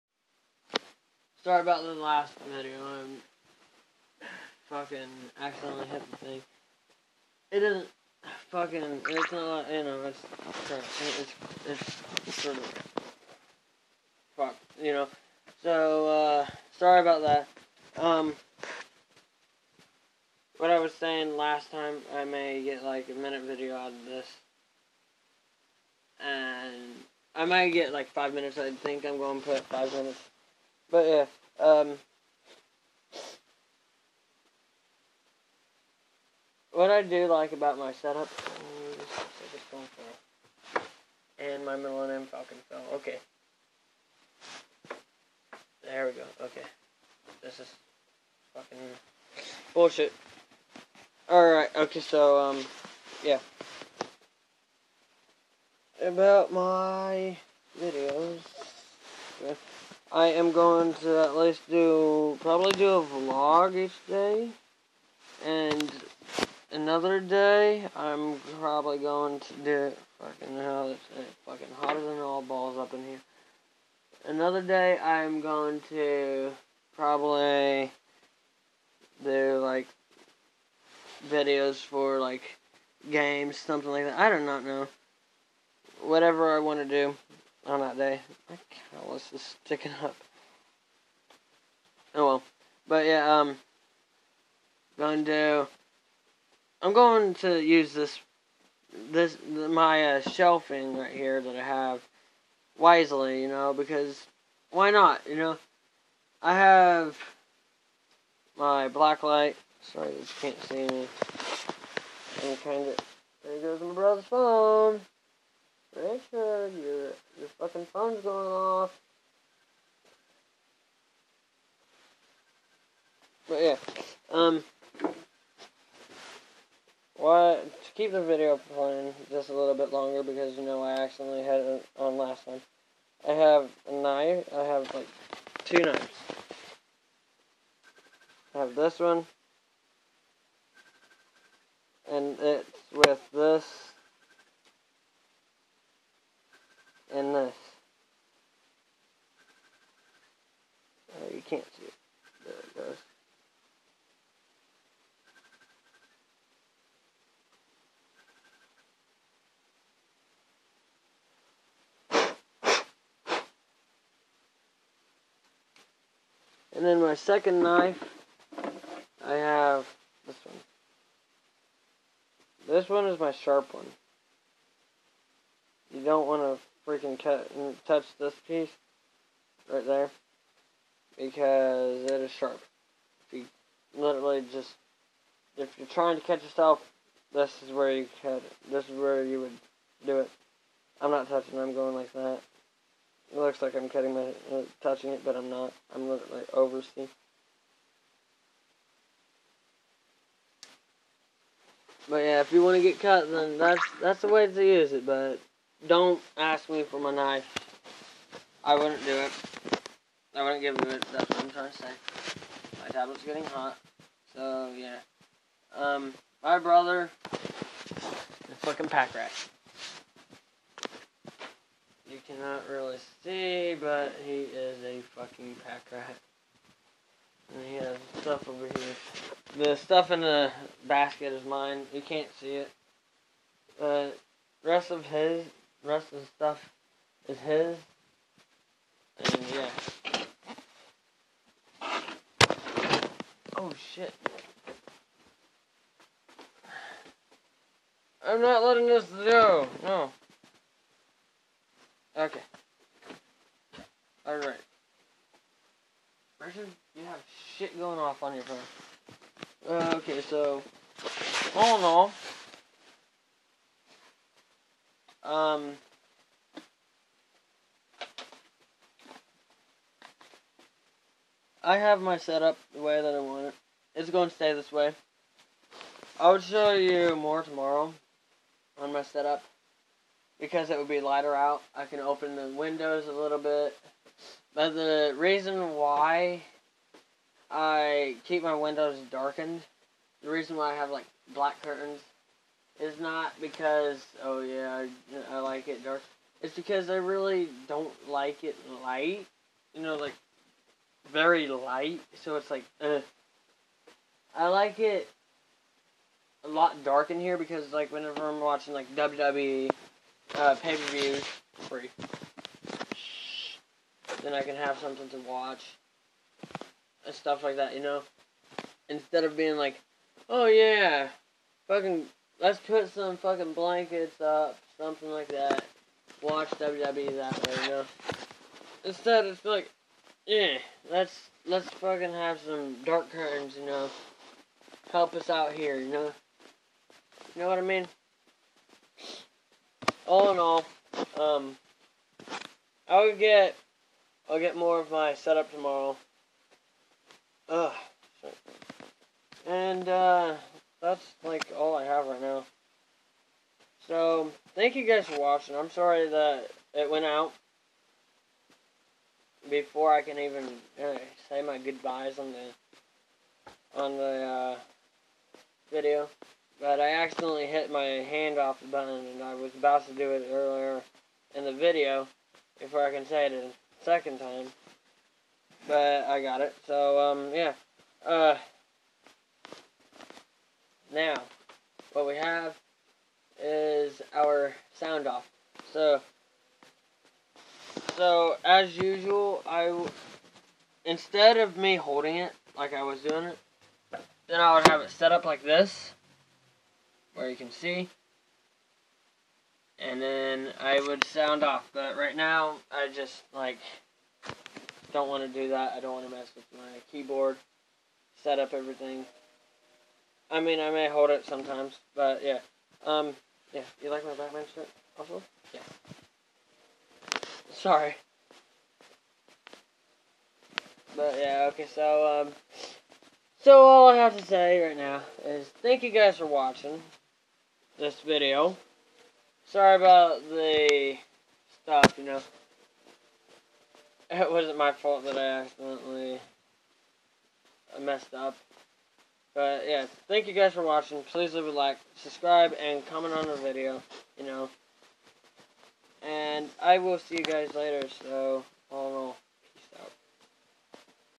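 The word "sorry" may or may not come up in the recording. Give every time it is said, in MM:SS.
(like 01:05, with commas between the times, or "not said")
00:01, 00:16, 01:49, 05:48, 05:55, 06:57, 07:09.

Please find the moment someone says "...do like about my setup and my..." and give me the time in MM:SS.
00:37.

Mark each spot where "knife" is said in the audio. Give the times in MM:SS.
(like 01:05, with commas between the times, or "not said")
02:13, 02:47, 03:27.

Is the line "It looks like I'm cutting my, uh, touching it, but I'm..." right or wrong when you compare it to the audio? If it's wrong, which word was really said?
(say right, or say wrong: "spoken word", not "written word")
right.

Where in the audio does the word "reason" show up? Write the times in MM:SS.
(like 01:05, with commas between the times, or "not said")
04:45, 04:50.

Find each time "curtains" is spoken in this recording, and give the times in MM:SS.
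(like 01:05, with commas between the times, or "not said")
04:51, 05:33.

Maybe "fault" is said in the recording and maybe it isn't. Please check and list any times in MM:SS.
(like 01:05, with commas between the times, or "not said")
07:14.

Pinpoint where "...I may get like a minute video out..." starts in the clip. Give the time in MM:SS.
00:22.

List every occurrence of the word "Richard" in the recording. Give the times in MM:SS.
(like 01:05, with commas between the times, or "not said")
01:55, 04:16.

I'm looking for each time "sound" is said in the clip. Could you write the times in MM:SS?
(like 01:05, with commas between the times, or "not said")
06:24, 06:41.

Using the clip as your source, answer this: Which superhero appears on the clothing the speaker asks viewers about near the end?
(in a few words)
Batman.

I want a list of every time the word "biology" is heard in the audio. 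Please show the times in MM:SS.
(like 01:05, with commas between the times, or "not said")
not said.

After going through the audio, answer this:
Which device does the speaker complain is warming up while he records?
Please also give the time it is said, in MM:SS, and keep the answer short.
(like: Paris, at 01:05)
tablet, at 03:32.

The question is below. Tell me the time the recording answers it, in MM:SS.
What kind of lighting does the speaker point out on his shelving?
01:48.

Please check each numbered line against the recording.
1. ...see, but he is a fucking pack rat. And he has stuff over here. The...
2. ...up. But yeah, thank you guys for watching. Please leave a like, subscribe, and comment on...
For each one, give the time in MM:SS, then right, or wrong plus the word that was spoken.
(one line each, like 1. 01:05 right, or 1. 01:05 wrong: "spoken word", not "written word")
1. 03:43 right
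2. 07:18 right.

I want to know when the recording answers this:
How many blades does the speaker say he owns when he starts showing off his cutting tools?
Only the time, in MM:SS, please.
02:15.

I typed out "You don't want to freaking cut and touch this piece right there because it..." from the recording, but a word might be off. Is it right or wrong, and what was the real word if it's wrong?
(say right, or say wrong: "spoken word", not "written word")
right.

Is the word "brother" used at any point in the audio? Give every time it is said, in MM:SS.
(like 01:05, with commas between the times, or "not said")
01:53, 03:36.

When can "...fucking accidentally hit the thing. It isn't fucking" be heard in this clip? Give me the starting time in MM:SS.
00:04.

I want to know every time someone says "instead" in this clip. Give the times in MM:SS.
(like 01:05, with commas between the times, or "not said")
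05:18, 05:28, 06:30.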